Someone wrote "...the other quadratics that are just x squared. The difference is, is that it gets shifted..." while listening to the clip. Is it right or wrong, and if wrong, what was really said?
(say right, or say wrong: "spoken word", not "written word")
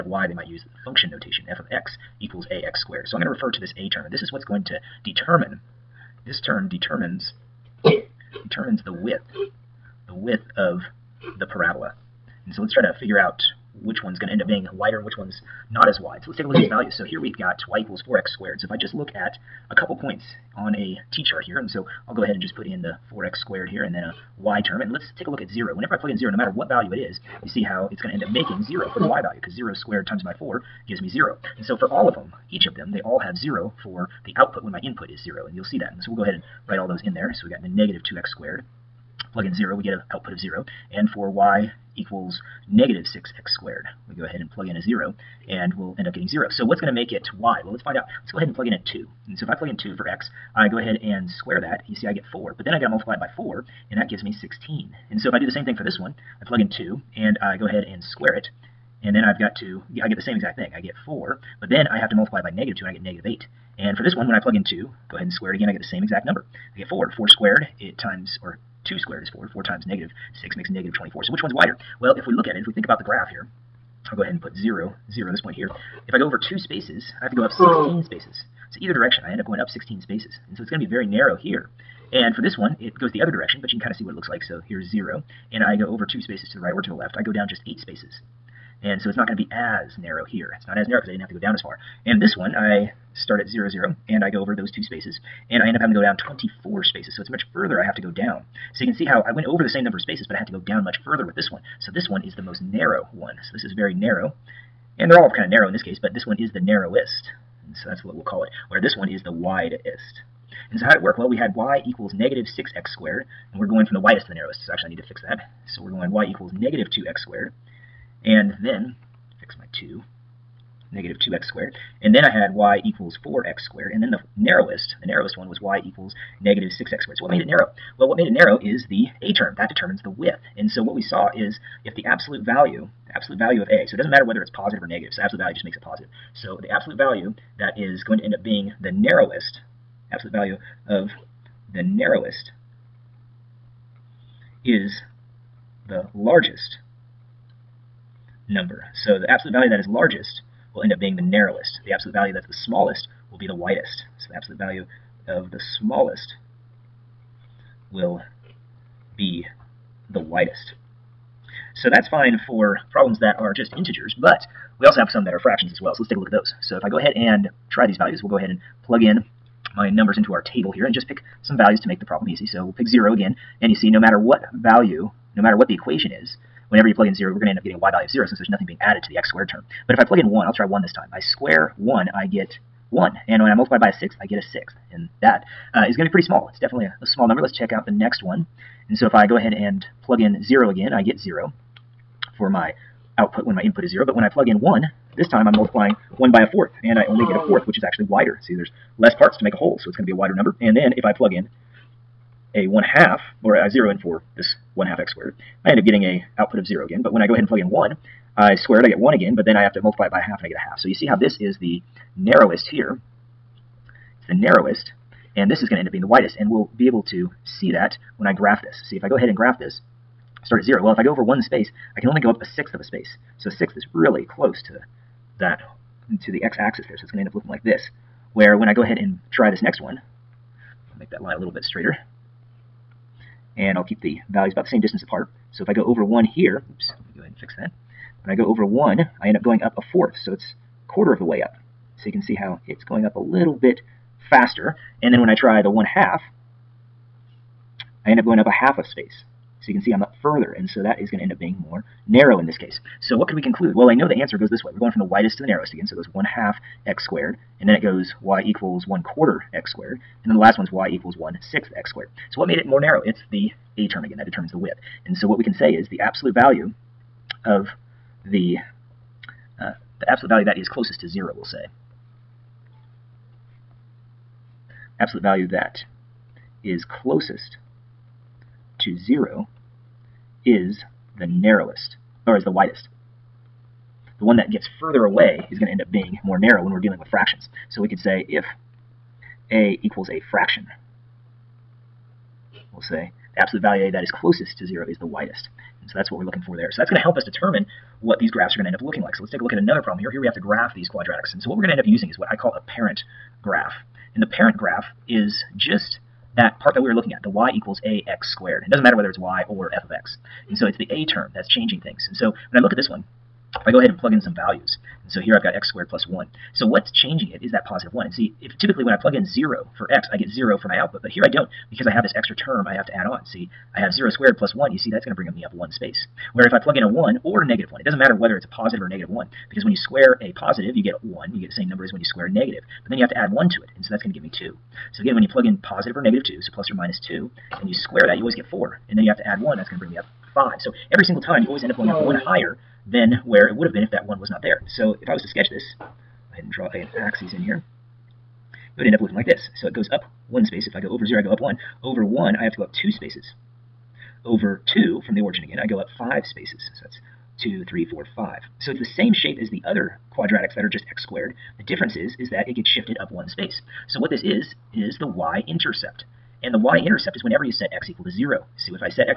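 right.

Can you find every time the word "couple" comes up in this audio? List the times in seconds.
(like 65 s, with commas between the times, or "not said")
19 s.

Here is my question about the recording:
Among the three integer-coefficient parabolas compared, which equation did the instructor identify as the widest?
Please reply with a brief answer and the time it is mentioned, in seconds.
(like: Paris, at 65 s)
y = -2x^2, at 116 s.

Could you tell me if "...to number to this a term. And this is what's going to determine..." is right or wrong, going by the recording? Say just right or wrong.
wrong.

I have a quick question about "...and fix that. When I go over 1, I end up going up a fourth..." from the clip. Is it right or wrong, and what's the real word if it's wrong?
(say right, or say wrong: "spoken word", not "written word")
right.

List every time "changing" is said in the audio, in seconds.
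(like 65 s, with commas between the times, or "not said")
311 s, 316 s.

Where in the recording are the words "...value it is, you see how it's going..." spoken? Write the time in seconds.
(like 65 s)
26 s.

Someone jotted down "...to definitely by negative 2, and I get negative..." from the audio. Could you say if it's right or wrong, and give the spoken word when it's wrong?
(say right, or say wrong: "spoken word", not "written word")
wrong: "multiply", not "definitely".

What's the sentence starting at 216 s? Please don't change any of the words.
And we'll be able to see that when I graph this.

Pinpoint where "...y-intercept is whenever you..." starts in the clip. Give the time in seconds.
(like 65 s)
366 s.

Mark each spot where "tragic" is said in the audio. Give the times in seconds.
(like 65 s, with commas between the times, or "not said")
not said.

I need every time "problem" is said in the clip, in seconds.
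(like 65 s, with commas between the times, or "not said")
162 s, 172 s, 299 s.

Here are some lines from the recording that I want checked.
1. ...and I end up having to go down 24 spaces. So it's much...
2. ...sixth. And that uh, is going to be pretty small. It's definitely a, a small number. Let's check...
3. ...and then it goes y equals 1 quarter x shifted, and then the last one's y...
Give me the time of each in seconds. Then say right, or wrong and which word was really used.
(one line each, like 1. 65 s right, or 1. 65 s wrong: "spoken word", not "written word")
1. 95 s right
2. 184 s right
3. 257 s wrong: "squared", not "shifted".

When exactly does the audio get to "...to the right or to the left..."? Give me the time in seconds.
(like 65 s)
86 s.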